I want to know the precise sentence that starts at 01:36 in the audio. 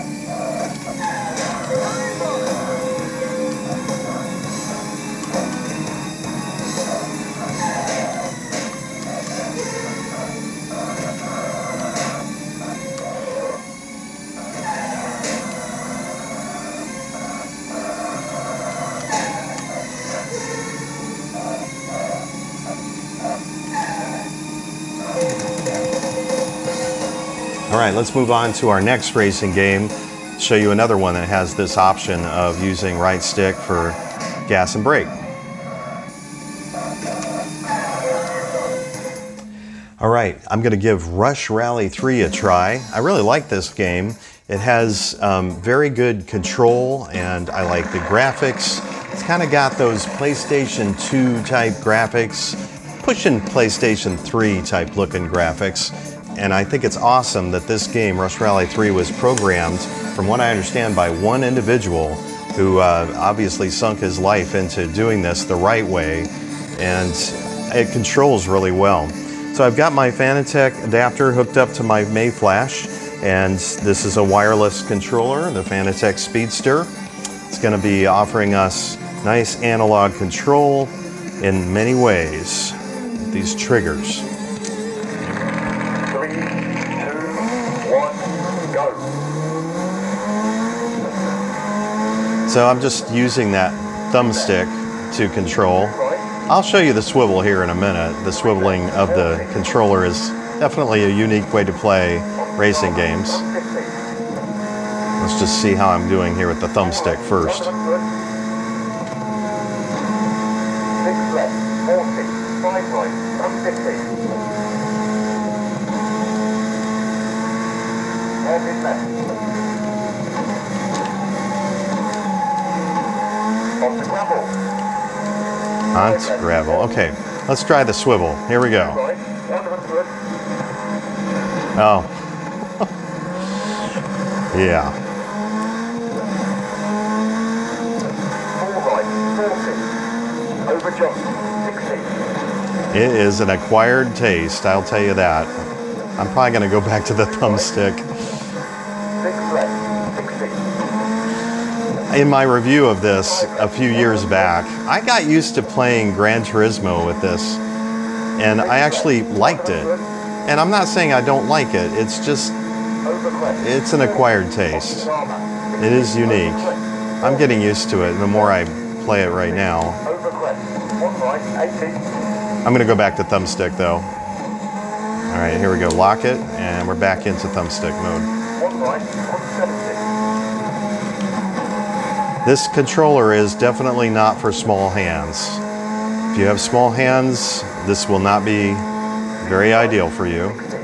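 I'll show you the swivel here in a minute.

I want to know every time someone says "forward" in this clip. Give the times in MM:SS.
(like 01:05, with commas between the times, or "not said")
not said.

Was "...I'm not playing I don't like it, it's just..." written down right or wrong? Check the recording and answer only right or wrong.
wrong.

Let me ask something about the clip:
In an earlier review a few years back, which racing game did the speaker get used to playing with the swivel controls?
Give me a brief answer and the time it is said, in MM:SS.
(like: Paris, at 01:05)
Gran Turismo, at 02:36.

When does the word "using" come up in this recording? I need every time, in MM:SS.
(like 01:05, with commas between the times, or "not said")
00:32, 01:33.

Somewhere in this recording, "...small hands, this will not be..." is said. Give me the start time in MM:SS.
03:06.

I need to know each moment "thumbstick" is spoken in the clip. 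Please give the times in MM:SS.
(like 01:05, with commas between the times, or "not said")
01:34, 01:46, 02:27, 02:53, 02:57.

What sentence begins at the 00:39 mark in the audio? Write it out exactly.
All right, I'm gonna give Rush Rally 3 a try.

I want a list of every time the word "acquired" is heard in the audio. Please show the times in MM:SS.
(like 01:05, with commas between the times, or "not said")
02:23, 02:44.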